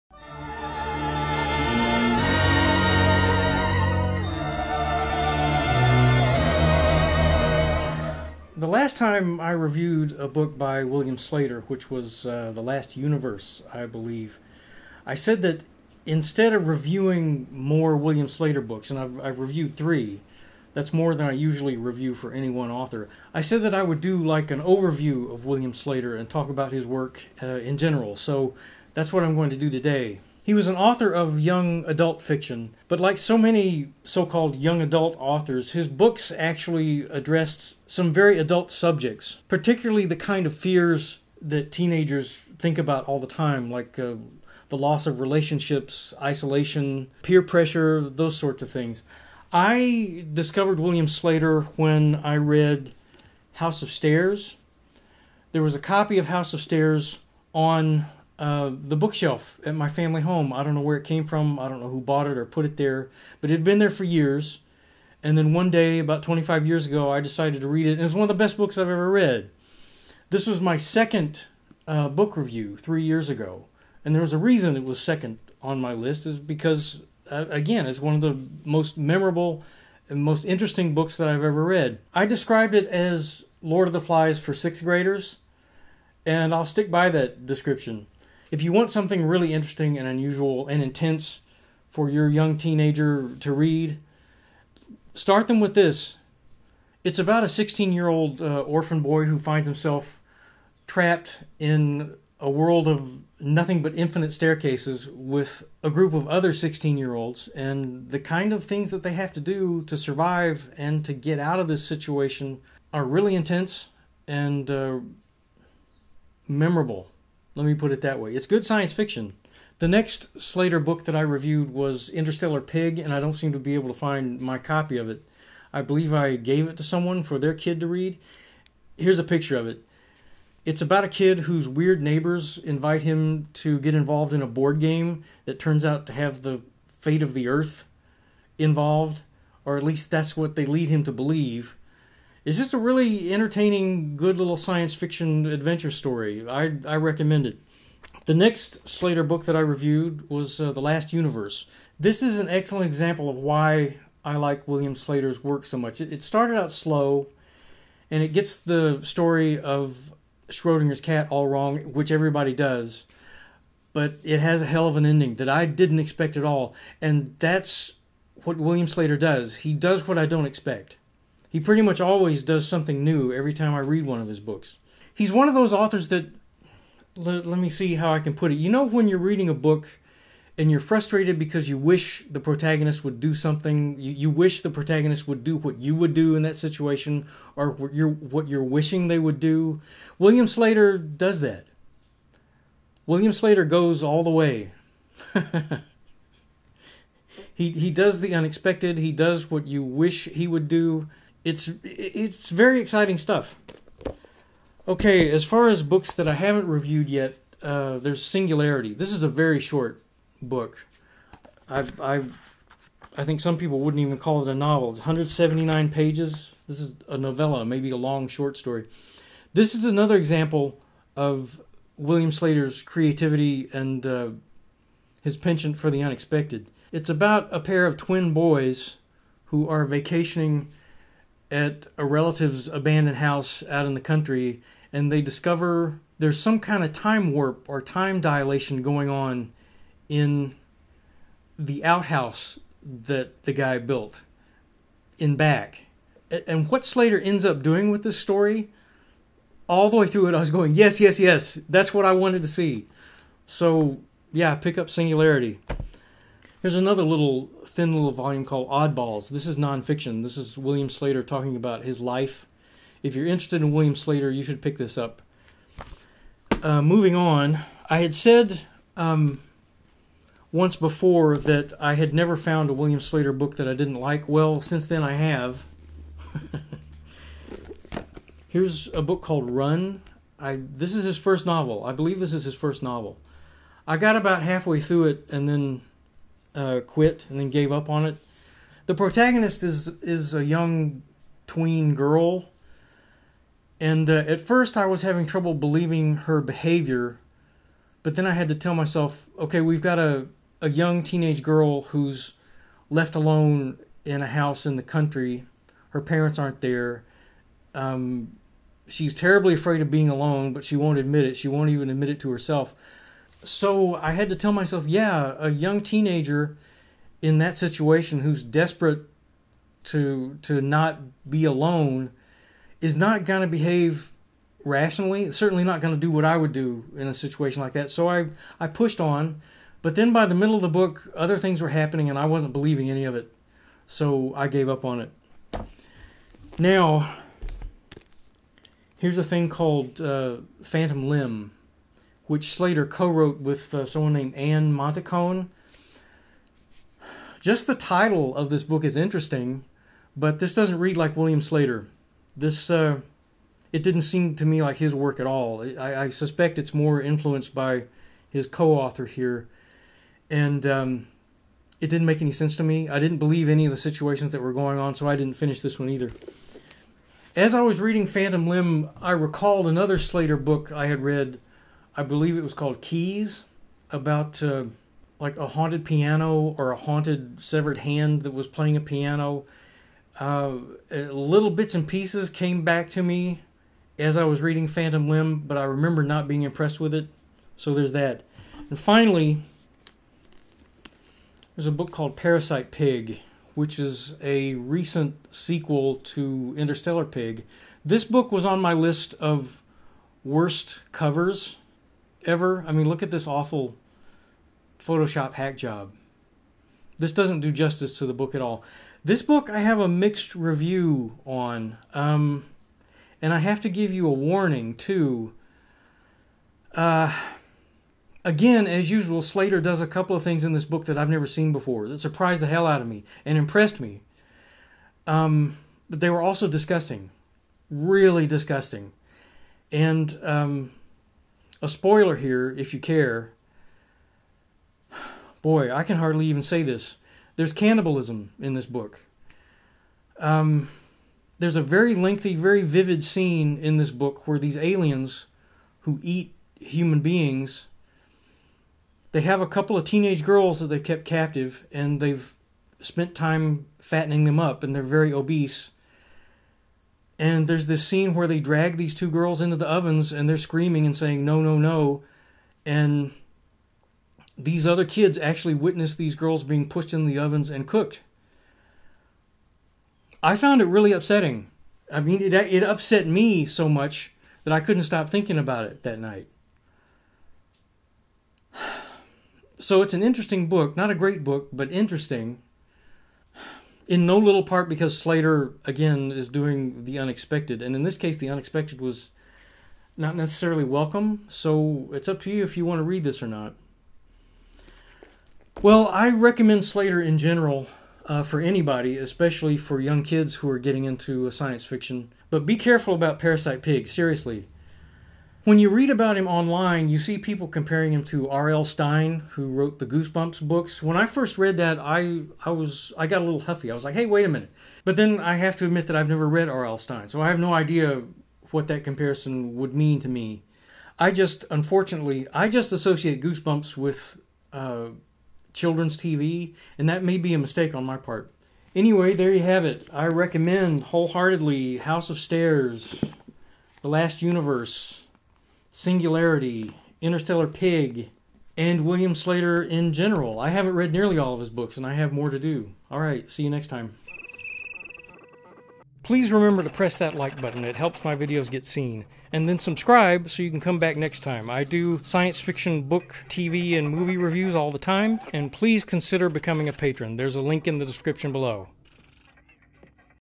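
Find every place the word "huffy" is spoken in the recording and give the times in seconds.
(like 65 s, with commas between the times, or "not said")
513 s.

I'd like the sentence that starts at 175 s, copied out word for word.
He's one of those authors that, let, let me see how I can put it.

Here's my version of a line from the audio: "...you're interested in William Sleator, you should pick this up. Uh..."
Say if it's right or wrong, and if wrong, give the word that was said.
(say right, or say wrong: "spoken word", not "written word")
right.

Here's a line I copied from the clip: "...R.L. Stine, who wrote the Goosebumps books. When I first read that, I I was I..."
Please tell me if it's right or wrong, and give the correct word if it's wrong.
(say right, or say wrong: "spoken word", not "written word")
right.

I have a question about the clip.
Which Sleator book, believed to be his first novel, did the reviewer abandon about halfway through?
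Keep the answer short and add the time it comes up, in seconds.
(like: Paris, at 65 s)
Run, at 279 s.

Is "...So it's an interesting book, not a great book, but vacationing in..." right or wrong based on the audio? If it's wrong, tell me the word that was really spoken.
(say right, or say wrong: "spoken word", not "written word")
wrong: "interesting", not "vacationing".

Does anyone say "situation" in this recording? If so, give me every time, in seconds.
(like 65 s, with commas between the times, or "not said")
111 s, 186 s, 317 s, 327 s, 363 s.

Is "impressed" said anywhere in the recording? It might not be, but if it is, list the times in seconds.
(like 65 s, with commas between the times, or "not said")
386 s, 423 s.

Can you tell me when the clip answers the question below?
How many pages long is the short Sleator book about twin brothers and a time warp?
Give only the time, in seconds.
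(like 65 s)
214 s.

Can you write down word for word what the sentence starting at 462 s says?
And these other kids actually witness these girls being pushed in the ovens and cooked.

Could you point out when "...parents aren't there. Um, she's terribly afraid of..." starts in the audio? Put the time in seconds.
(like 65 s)
306 s.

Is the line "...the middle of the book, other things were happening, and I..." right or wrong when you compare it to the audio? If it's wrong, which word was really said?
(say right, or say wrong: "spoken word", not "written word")
right.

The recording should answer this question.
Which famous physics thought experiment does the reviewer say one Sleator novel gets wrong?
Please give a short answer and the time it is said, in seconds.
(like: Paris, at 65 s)
Schrodinger's cat, at 160 s.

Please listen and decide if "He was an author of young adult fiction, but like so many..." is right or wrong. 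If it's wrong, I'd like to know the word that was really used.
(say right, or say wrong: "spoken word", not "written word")
right.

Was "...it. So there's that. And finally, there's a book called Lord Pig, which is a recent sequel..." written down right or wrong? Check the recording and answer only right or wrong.
wrong.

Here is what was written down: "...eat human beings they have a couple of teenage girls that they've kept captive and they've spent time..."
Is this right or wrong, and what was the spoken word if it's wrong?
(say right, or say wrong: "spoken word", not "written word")
right.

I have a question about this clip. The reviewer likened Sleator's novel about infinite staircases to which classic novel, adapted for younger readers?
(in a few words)
Lord of the Flies.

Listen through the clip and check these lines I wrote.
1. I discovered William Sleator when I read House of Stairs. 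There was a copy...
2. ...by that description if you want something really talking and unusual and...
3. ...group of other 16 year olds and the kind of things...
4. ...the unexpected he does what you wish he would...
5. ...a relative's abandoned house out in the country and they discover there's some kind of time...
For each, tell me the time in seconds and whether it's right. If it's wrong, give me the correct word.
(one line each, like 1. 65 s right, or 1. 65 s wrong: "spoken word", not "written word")
1. 49 s right
2. 86 s wrong: "interesting", not "talking"
3. 105 s right
4. 198 s right
5. 231 s right.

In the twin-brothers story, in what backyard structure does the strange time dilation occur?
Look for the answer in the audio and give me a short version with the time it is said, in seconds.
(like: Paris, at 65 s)
the outhouse, at 241 s.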